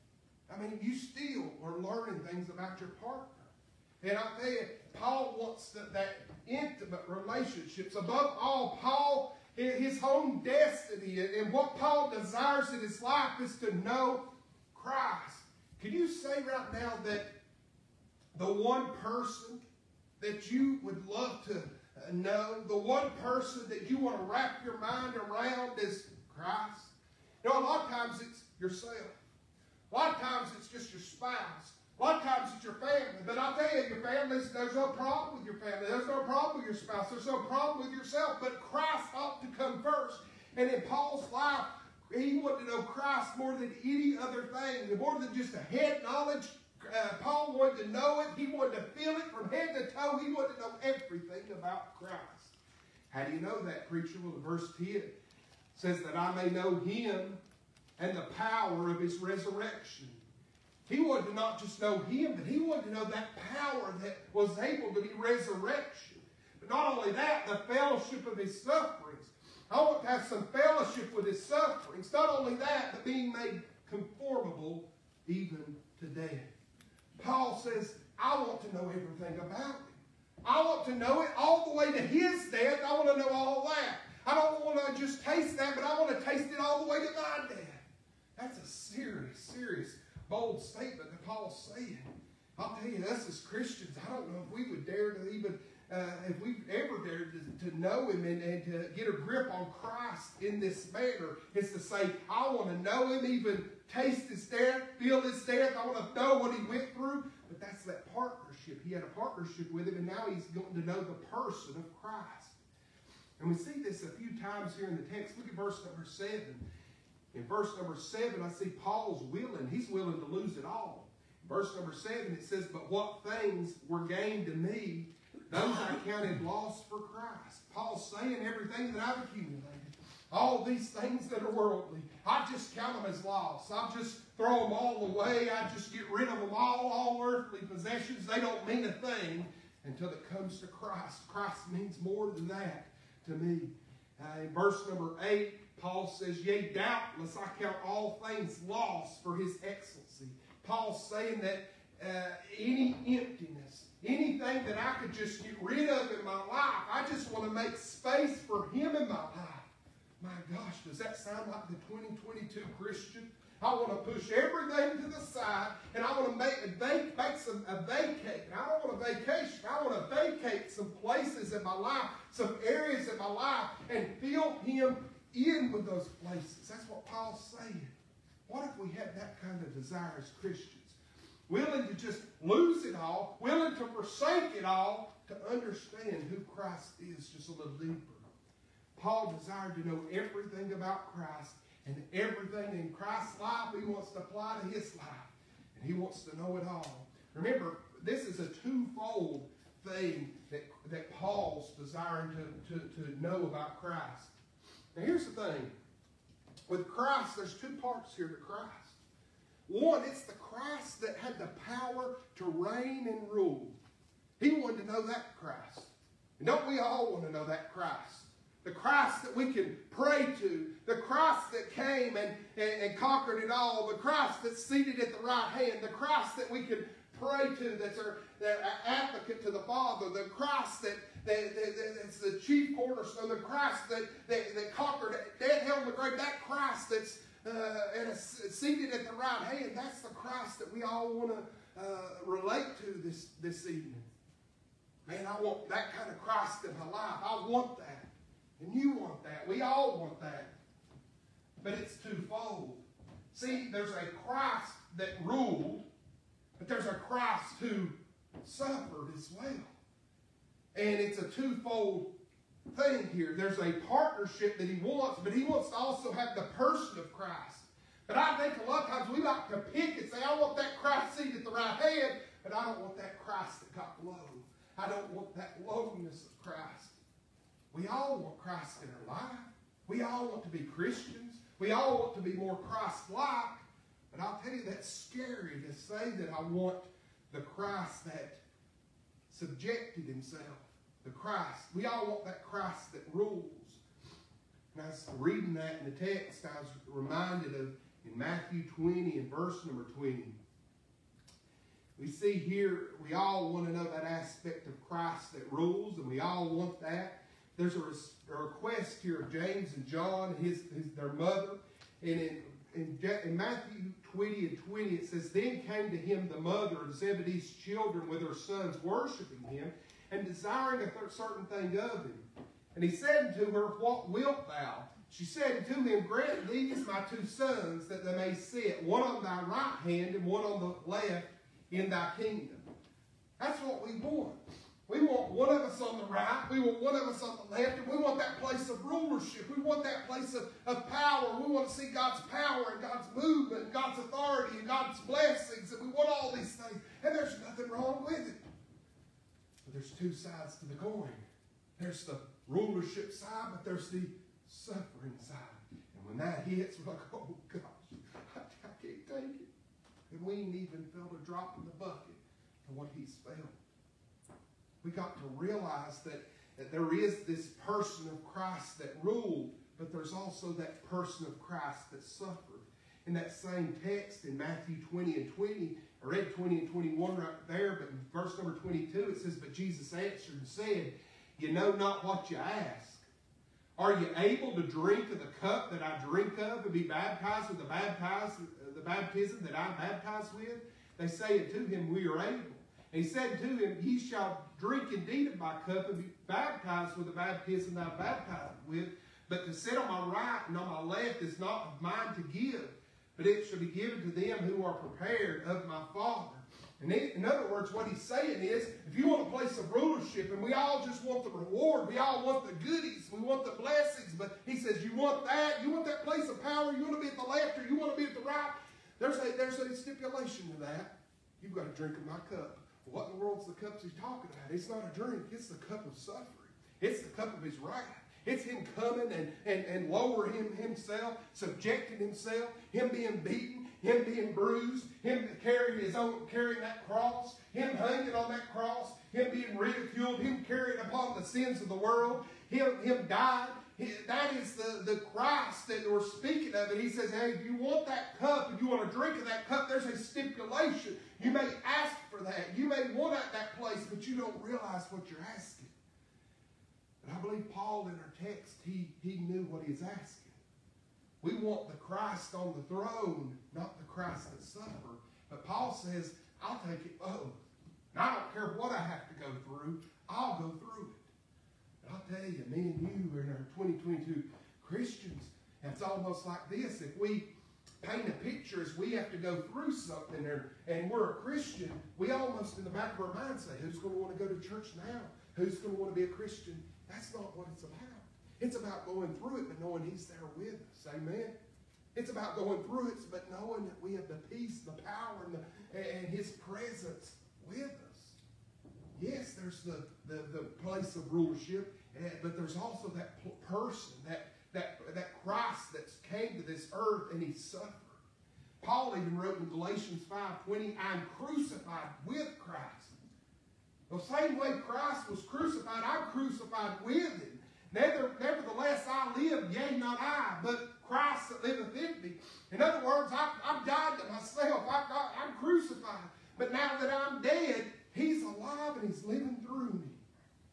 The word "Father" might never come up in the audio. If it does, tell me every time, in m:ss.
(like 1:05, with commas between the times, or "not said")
3:49, 6:45.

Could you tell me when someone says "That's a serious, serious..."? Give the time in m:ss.
1:28.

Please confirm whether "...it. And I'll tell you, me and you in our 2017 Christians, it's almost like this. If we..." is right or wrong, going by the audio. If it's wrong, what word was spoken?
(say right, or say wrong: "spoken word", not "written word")
wrong: "2022", not "2017".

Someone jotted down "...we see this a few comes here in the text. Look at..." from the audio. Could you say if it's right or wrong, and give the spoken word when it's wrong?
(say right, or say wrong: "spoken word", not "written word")
wrong: "times", not "comes".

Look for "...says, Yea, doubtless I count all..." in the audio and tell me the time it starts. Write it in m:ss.
2:26.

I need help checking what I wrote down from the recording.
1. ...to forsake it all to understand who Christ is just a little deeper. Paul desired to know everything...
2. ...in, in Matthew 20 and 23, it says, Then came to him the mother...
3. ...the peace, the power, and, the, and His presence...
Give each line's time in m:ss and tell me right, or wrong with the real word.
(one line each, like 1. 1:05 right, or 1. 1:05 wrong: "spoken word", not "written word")
1. 3:03 right
2. 5:12 wrong: "20", not "23"
3. 8:14 right.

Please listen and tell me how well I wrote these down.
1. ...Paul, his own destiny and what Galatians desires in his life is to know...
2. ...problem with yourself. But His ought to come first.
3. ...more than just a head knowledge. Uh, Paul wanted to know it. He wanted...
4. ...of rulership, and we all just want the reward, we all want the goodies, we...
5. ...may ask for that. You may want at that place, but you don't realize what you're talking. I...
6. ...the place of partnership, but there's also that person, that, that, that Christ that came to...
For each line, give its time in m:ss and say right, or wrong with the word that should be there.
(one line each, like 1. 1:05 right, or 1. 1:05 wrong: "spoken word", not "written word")
1. 0:08 wrong: "Paul", not "Galatians"
2. 0:37 wrong: "Christ", not "His"
3. 0:44 right
4. 6:49 right
5. 7:31 wrong: "asking", not "talking"
6. 8:20 wrong: "rulership", not "partnership".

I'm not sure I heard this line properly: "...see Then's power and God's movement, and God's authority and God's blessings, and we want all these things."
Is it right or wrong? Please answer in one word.
wrong.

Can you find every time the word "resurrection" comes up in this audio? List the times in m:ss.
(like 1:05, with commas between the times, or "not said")
0:59, 1:05.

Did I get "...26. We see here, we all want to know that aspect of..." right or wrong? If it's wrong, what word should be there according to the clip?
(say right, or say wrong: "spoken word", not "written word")
wrong: "20", not "26".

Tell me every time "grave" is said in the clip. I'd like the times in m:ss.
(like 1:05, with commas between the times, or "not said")
3:55.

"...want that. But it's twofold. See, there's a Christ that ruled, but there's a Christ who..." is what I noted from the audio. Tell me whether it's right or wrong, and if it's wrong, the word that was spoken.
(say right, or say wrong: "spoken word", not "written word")
right.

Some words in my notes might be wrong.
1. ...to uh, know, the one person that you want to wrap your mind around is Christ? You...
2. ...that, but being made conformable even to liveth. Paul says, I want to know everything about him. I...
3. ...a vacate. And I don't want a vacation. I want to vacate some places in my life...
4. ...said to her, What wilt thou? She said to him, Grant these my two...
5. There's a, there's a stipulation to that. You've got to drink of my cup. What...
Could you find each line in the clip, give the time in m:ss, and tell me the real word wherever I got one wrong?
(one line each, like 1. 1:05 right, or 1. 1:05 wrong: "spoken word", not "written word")
1. 0:21 right
2. 1:12 wrong: "death", not "liveth"
3. 2:47 right
4. 5:22 right
5. 6:58 right.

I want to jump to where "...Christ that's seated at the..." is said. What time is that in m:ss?
3:43.